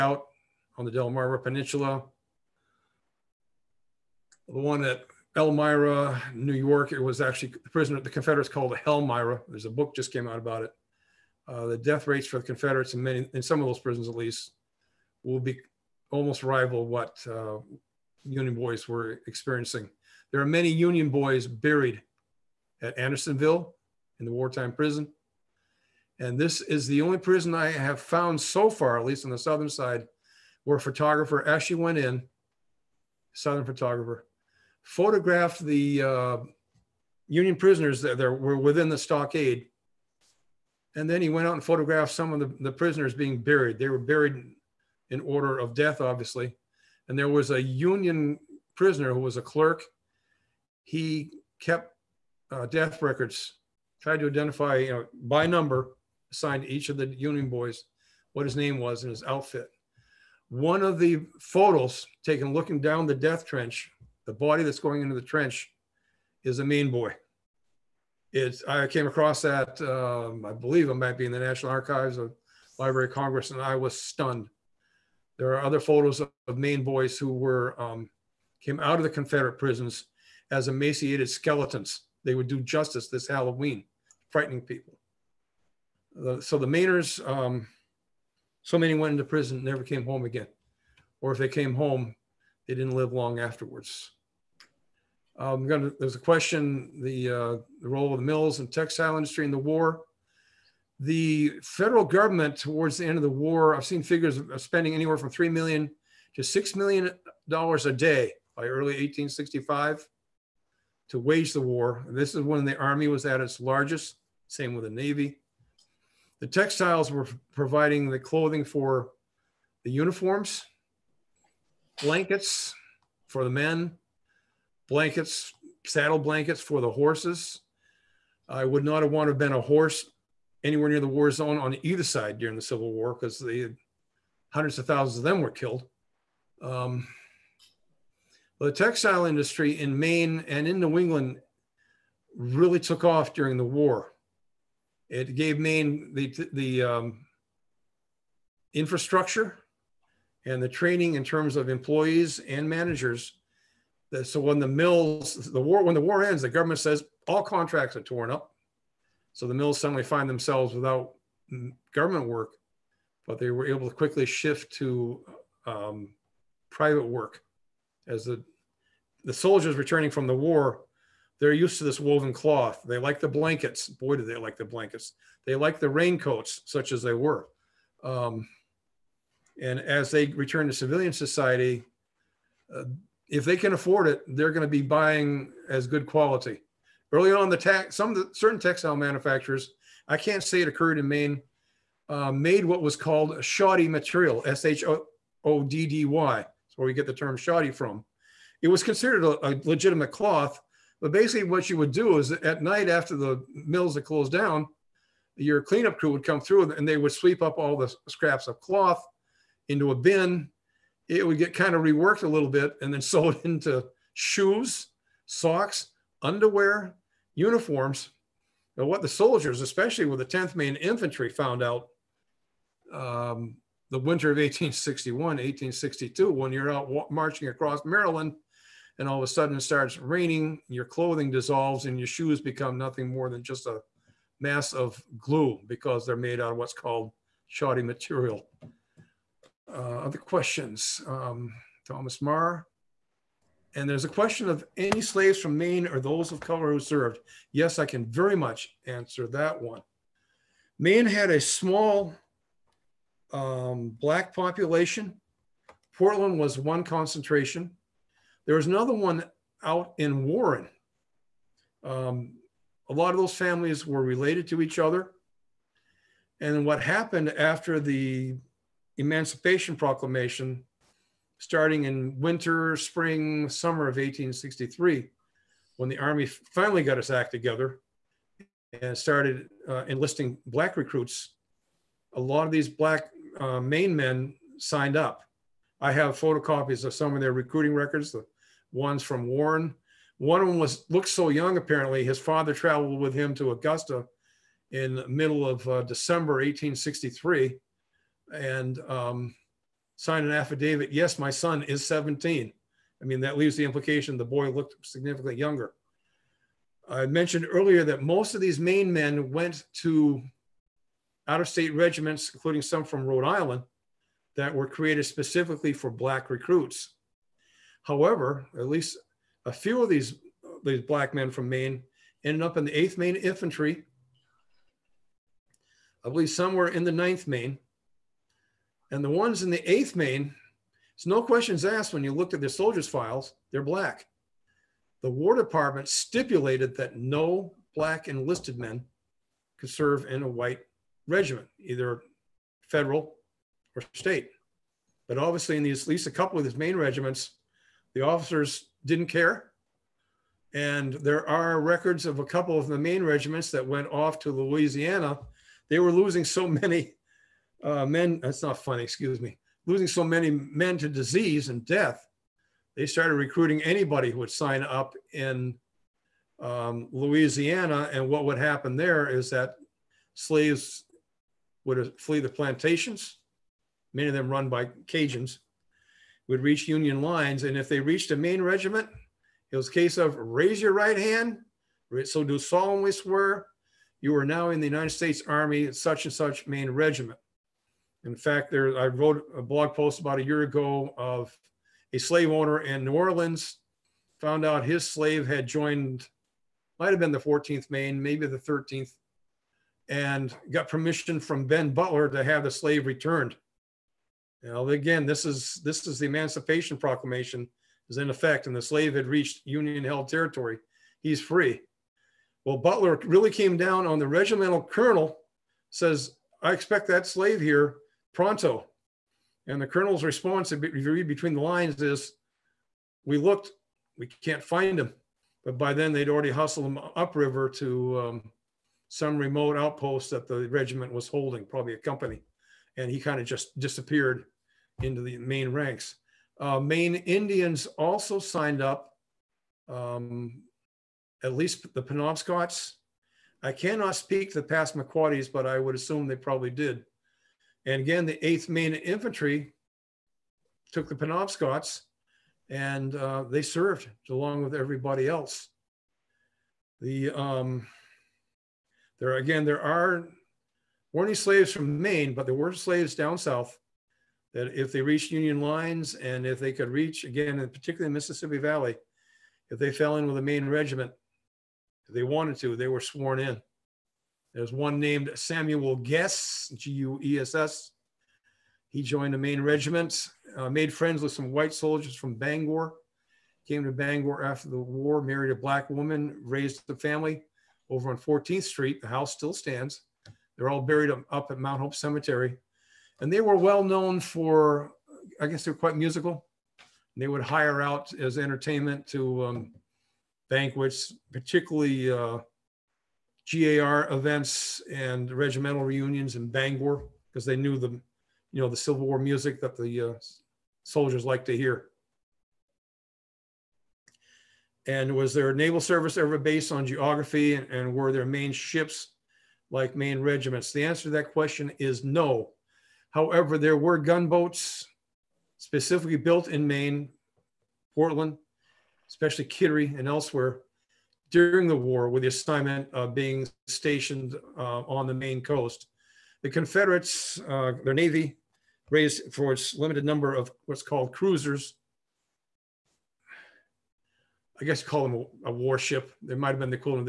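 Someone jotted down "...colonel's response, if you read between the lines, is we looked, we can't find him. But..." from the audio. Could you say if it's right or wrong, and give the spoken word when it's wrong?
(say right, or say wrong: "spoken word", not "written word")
right.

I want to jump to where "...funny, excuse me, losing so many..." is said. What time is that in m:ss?
5:58.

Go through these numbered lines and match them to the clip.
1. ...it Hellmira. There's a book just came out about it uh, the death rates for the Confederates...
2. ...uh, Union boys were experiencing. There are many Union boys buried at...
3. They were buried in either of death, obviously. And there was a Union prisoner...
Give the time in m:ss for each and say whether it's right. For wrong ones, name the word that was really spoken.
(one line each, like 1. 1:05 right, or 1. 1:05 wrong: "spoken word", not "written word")
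1. 0:08 right
2. 0:17 right
3. 0:43 wrong: "order", not "either".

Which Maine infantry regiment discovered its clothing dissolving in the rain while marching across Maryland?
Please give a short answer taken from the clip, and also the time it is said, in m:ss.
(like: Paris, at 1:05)
10th Maine Infantry, at 3:40.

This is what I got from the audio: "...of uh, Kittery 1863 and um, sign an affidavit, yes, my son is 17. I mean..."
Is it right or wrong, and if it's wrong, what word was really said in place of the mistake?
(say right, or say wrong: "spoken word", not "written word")
wrong: "December", not "Kittery".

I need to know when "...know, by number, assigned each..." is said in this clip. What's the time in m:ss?
0:54.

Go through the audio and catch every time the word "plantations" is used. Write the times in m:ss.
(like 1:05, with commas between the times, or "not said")
6:12.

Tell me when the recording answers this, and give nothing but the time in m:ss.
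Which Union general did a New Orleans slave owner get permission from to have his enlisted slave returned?
6:41.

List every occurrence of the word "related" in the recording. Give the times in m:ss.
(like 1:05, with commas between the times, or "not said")
4:24.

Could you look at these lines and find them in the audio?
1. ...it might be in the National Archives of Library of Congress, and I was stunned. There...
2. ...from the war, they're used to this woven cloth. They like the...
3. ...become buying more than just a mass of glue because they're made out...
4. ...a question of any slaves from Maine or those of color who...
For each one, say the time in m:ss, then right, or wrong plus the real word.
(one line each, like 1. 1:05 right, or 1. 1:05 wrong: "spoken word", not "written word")
1. 1:10 right
2. 2:50 right
3. 3:52 wrong: "nothing", not "buying"
4. 4:04 right.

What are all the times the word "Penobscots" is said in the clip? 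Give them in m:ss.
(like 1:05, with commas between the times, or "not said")
7:21, 7:30.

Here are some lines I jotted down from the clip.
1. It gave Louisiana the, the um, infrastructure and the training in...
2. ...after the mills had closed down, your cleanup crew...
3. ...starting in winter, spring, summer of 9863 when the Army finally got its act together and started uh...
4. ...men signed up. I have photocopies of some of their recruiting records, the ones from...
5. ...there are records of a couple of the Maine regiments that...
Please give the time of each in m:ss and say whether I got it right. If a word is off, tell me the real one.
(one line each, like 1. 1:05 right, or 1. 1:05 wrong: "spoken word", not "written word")
1. 2:25 wrong: "Maine", not "Louisiana"
2. 3:22 right
3. 4:31 wrong: "1863", not "9863"
4. 4:43 right
5. 5:50 right.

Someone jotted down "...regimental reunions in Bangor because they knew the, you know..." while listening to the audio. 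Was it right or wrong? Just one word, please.
right.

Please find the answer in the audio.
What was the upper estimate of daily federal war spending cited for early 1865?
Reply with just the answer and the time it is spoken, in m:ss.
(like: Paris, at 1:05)
6 million dollars, at 1:46.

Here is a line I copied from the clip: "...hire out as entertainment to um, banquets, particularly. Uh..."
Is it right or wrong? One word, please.
right.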